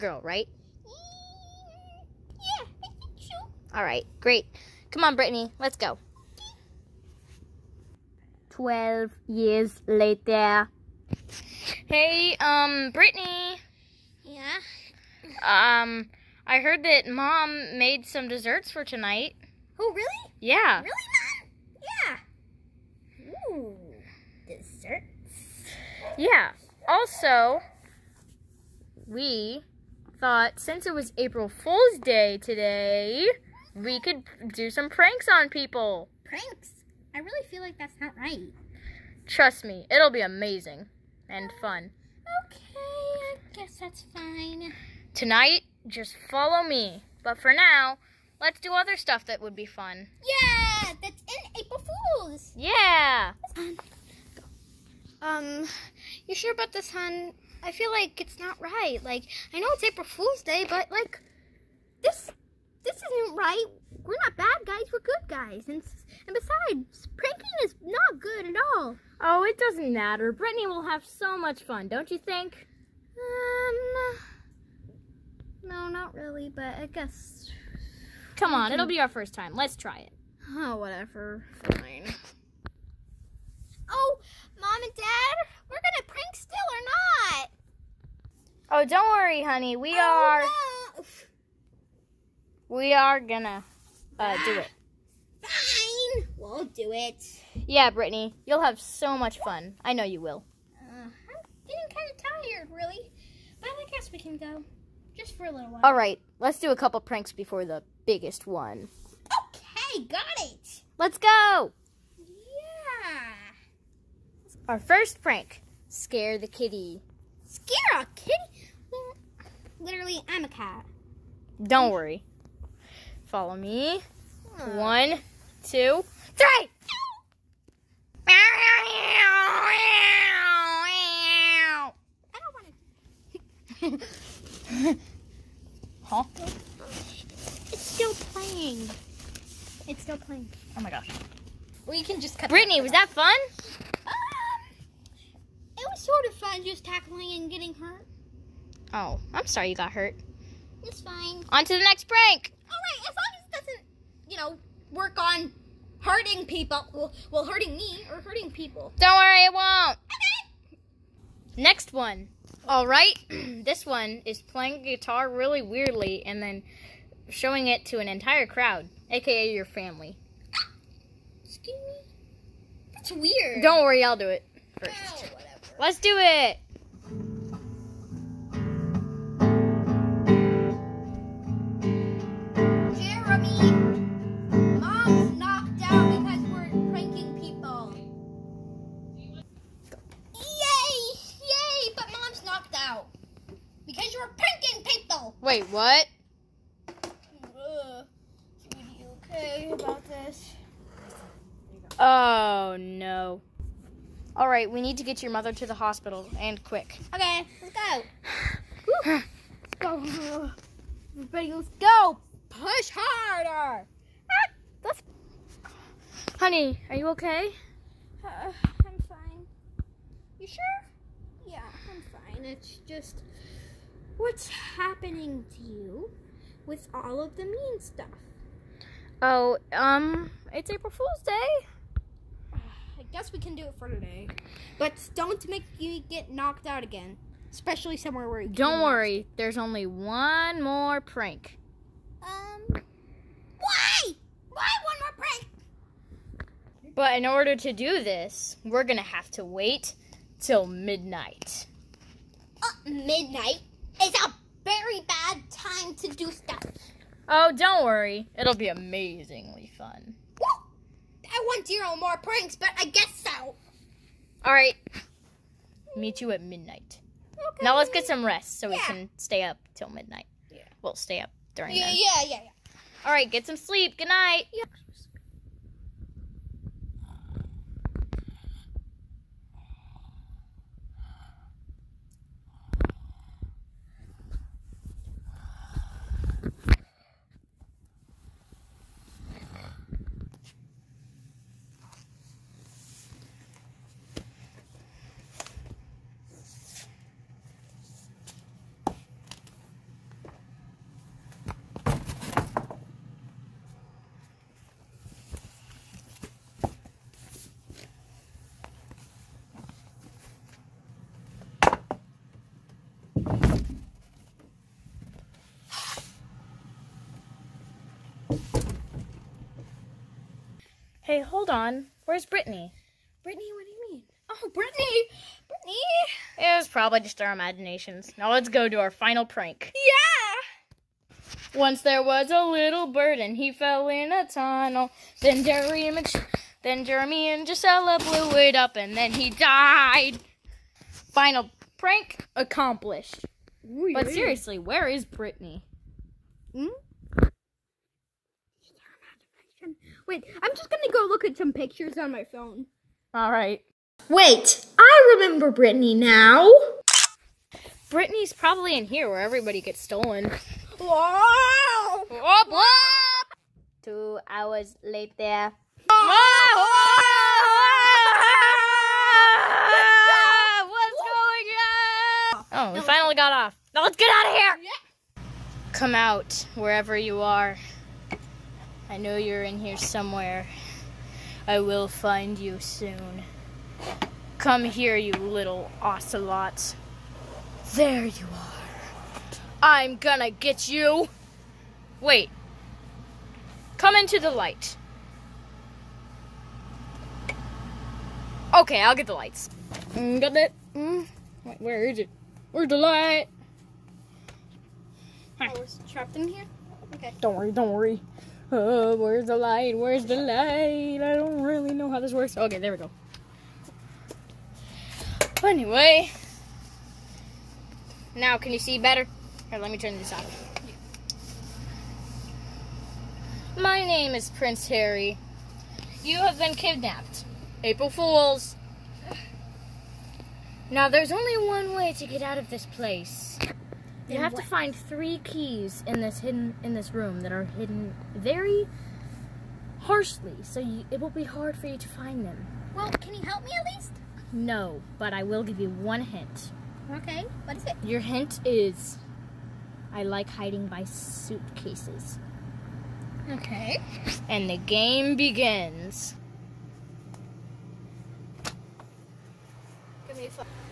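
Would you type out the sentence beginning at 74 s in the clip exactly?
Um, no, not really, but I guess...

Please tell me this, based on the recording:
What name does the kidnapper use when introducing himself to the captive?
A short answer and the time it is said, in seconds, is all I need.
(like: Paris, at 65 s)
Prince Harry, at 424 s.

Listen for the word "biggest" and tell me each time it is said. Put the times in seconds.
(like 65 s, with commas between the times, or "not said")
108 s.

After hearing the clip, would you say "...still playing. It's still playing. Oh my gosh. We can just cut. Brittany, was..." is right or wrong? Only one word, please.
right.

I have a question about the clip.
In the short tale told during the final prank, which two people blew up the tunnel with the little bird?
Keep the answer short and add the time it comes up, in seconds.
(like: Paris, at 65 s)
Jeremy and Gisella, at 336 s.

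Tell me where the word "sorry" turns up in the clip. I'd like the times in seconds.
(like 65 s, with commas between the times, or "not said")
149 s.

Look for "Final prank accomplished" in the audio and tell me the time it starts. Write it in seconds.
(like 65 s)
340 s.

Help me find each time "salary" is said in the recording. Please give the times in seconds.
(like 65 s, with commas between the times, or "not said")
not said.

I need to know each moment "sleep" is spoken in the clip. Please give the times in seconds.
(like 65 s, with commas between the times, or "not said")
273 s.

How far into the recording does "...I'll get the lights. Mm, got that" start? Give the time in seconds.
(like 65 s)
398 s.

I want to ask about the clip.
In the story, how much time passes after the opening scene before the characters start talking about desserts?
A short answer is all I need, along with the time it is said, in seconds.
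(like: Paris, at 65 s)
12 years, at 8 s.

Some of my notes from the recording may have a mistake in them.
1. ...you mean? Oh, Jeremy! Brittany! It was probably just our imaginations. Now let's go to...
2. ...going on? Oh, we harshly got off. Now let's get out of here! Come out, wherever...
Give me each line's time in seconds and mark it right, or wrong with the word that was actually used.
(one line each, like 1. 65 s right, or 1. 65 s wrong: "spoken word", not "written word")
1. 323 s wrong: "Brittany", not "Jeremy"
2. 371 s wrong: "finally", not "harshly".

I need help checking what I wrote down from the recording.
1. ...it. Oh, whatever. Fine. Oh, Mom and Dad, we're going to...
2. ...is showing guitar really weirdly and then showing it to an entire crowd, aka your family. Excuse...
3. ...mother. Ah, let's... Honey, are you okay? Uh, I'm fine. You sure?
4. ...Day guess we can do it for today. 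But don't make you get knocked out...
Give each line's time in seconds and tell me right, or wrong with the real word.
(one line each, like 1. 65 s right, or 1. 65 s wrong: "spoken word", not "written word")
1. 79 s right
2. 164 s wrong: "playing", not "showing"
3. 212 s wrong: "harder", not "mother"
4. 231 s right.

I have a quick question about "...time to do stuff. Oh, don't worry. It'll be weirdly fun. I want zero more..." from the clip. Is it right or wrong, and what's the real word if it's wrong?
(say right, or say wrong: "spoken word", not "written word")
wrong: "amazingly", not "weirdly".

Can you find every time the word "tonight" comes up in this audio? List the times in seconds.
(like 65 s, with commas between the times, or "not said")
18 s, 45 s.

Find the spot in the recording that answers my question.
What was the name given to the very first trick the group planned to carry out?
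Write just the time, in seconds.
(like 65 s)
115 s.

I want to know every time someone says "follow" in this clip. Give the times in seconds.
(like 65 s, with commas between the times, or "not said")
46 s, 123 s.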